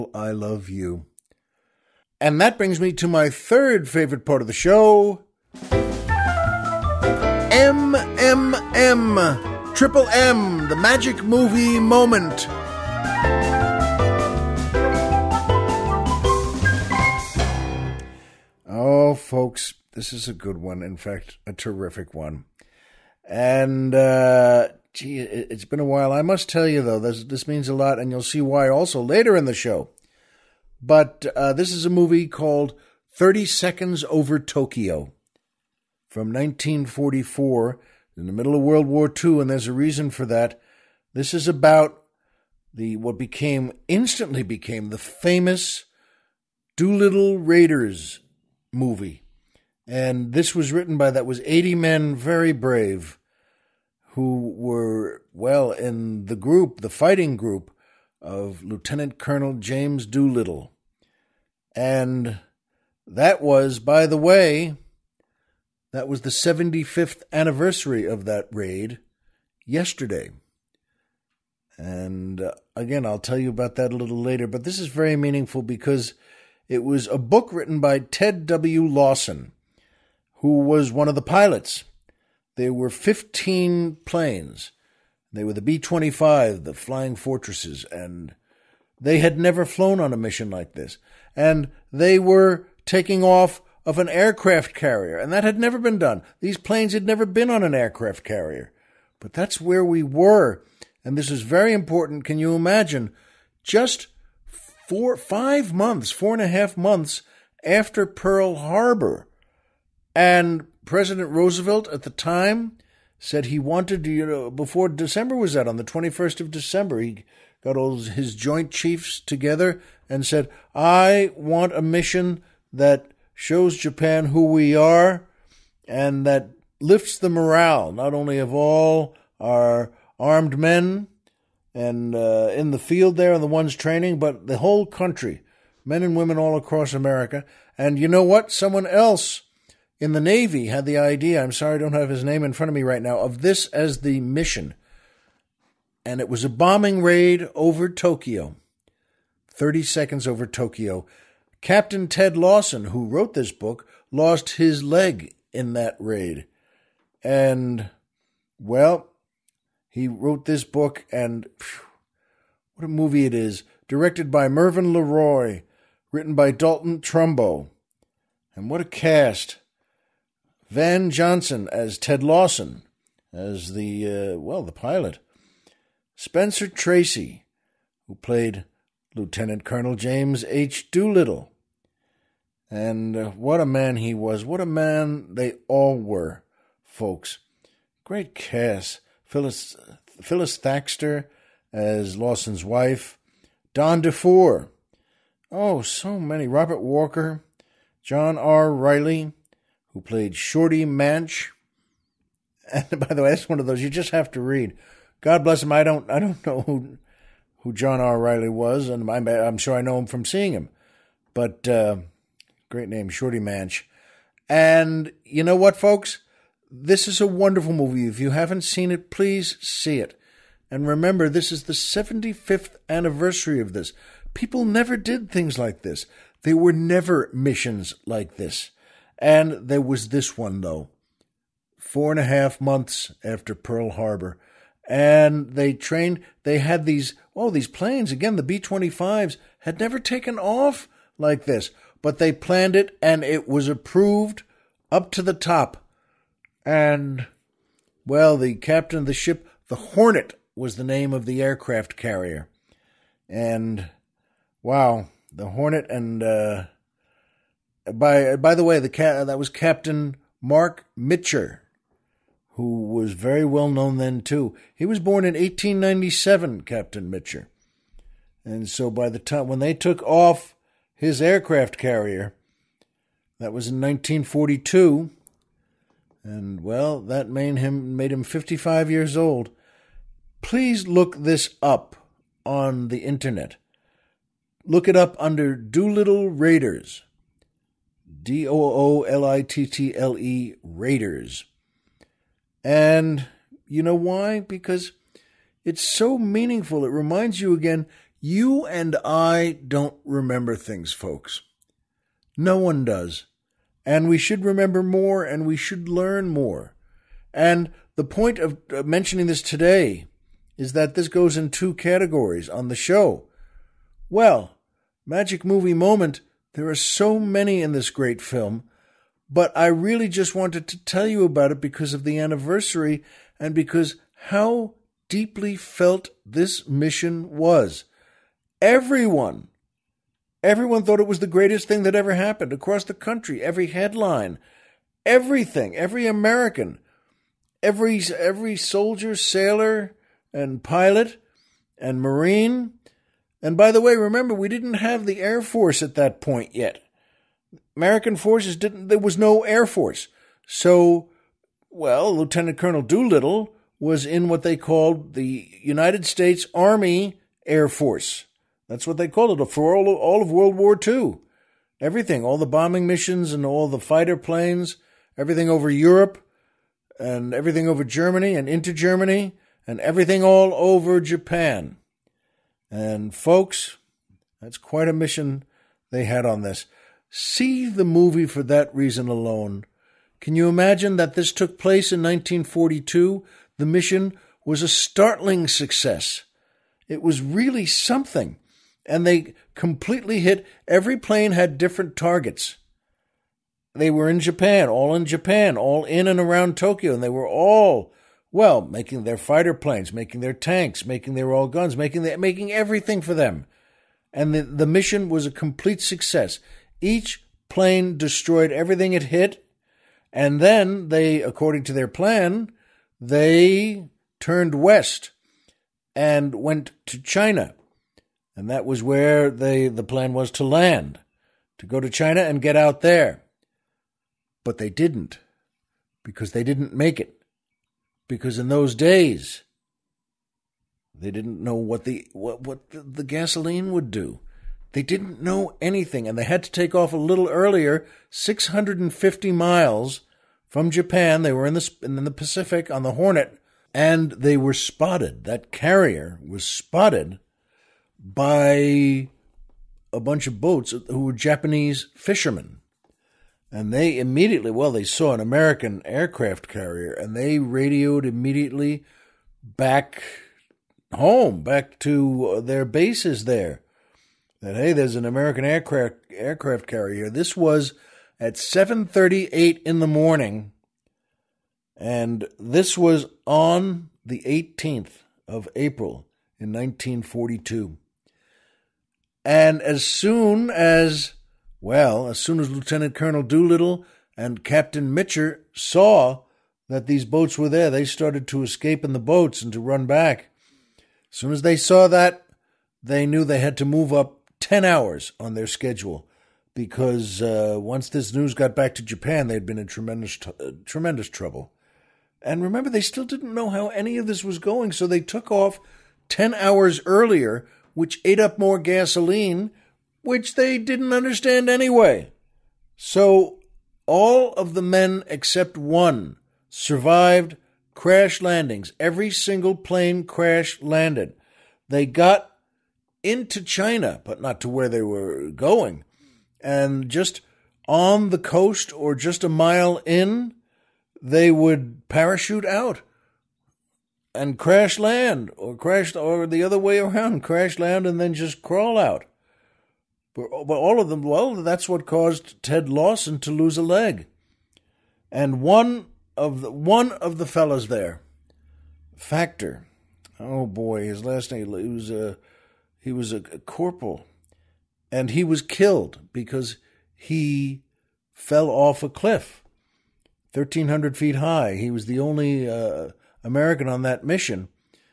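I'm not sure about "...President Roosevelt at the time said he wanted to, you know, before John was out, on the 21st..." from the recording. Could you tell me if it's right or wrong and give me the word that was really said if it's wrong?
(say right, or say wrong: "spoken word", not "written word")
wrong: "December", not "John".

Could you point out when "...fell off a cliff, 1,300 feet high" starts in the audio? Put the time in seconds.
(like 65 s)
558 s.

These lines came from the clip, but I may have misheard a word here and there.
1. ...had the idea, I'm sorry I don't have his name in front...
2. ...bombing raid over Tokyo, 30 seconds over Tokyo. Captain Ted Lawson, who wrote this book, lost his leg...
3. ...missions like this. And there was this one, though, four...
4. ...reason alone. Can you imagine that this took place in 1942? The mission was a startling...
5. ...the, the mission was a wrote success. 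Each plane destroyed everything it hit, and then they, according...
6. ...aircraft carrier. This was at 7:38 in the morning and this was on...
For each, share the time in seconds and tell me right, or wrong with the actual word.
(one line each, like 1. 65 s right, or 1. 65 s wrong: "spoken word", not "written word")
1. 140 s right
2. 146 s right
3. 227 s right
4. 378 s right
5. 404 s wrong: "complete", not "wrote"
6. 466 s right.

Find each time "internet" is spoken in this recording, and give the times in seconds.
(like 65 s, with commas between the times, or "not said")
282 s.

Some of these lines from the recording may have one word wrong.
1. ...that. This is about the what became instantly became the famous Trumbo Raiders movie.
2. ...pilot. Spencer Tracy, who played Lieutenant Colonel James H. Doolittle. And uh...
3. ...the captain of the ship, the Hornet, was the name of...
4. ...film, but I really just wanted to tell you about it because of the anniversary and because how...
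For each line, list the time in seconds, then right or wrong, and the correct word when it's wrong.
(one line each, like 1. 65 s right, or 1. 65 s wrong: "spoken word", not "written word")
1. 40 s wrong: "Doolittle", not "Trumbo"
2. 174 s right
3. 248 s right
4. 318 s right.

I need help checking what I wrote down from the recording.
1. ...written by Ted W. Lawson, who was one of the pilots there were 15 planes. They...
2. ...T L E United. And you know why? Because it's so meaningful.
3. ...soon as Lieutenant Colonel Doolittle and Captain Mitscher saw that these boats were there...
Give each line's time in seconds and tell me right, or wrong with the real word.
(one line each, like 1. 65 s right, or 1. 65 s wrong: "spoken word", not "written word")
1. 77 s right
2. 289 s wrong: "Raiders", not "United"
3. 482 s right.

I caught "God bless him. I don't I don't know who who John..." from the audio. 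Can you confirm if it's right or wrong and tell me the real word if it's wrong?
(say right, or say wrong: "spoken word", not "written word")
right.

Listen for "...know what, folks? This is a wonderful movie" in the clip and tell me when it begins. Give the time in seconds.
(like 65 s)
215 s.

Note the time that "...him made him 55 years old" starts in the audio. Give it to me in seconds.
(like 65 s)
277 s.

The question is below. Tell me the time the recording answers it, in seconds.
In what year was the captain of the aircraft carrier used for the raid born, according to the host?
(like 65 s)
265 s.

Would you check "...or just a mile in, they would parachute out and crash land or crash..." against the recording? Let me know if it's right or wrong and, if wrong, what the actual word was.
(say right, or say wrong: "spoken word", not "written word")
right.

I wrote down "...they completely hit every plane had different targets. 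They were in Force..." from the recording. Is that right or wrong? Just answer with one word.
wrong.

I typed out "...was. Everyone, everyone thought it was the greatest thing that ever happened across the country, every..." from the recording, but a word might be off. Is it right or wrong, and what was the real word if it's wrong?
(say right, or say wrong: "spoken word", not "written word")
right.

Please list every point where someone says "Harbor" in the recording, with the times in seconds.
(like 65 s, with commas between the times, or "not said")
108 s, 233 s.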